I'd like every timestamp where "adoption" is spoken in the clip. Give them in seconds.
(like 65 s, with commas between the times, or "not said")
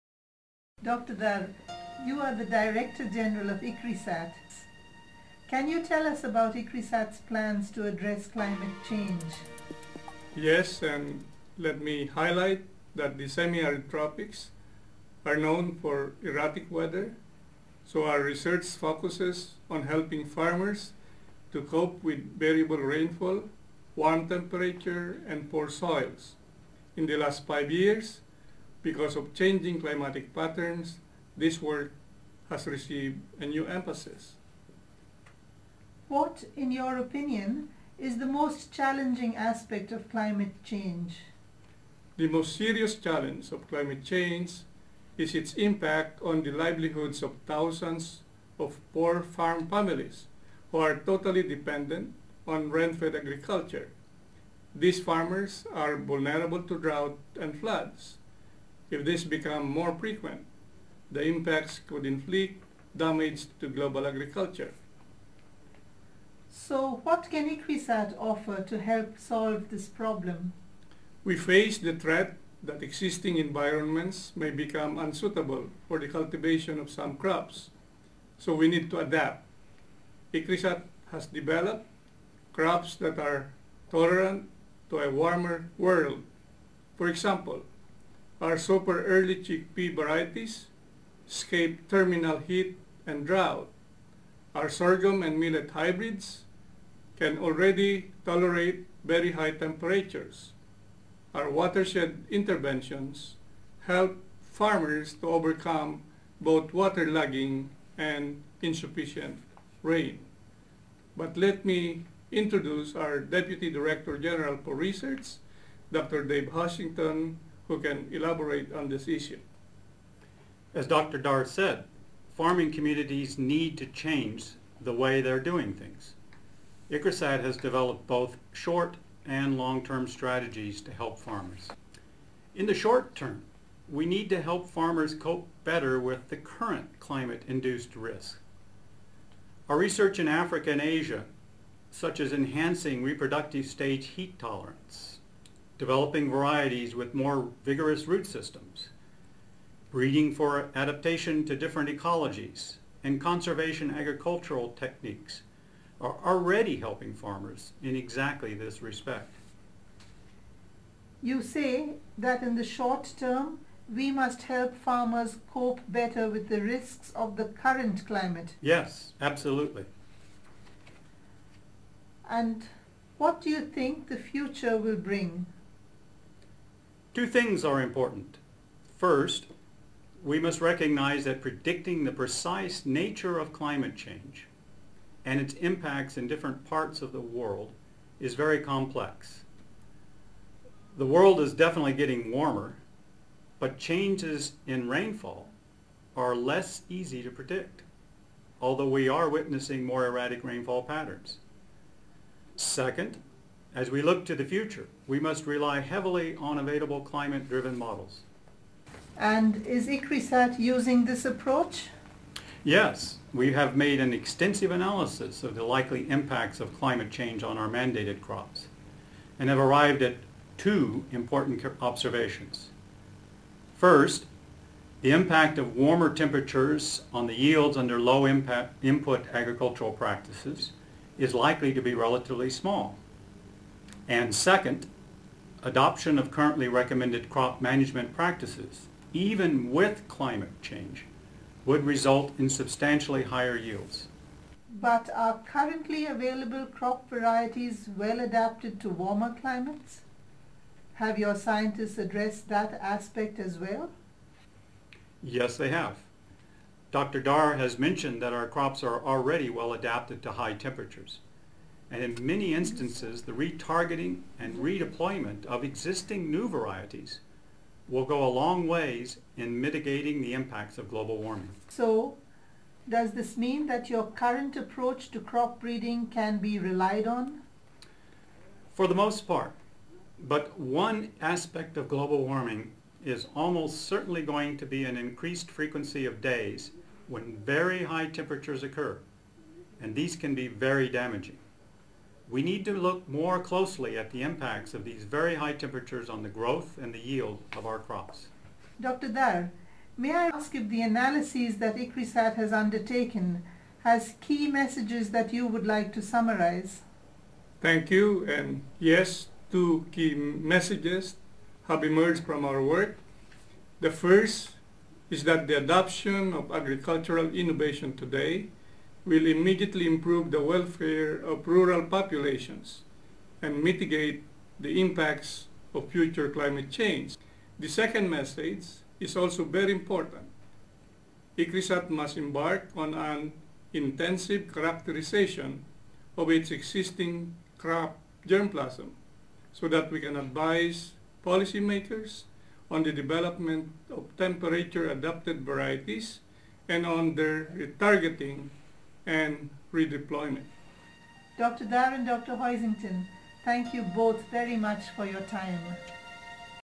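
235 s, 315 s.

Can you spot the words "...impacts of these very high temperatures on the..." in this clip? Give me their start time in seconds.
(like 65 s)
294 s.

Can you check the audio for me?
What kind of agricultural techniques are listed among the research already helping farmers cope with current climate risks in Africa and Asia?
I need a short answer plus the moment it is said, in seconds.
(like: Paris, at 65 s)
Conservation agricultural techniques, at 153 s.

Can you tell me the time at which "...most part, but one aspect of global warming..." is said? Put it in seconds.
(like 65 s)
278 s.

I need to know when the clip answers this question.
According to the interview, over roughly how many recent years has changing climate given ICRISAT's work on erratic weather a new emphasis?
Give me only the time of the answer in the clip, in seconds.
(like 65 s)
27 s.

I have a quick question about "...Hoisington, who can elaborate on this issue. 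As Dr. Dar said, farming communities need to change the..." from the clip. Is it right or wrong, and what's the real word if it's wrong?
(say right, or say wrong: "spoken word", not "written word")
right.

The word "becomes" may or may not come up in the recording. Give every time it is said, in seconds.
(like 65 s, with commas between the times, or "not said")
59 s, 74 s.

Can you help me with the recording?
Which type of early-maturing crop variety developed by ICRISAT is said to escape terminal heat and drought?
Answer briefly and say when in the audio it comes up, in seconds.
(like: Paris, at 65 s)
Super early chickpea, at 88 s.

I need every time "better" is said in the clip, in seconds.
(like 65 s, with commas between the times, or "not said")
135 s, 165 s.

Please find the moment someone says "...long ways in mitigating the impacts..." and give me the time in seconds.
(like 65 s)
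268 s.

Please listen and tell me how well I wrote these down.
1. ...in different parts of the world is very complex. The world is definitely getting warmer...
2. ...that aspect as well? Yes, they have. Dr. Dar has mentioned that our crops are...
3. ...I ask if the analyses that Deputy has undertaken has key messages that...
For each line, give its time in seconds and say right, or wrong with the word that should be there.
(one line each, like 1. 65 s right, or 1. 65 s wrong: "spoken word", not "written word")
1. 186 s right
2. 252 s right
3. 300 s wrong: "ICRISAT", not "Deputy".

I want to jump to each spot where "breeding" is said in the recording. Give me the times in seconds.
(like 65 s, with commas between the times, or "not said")
149 s, 275 s.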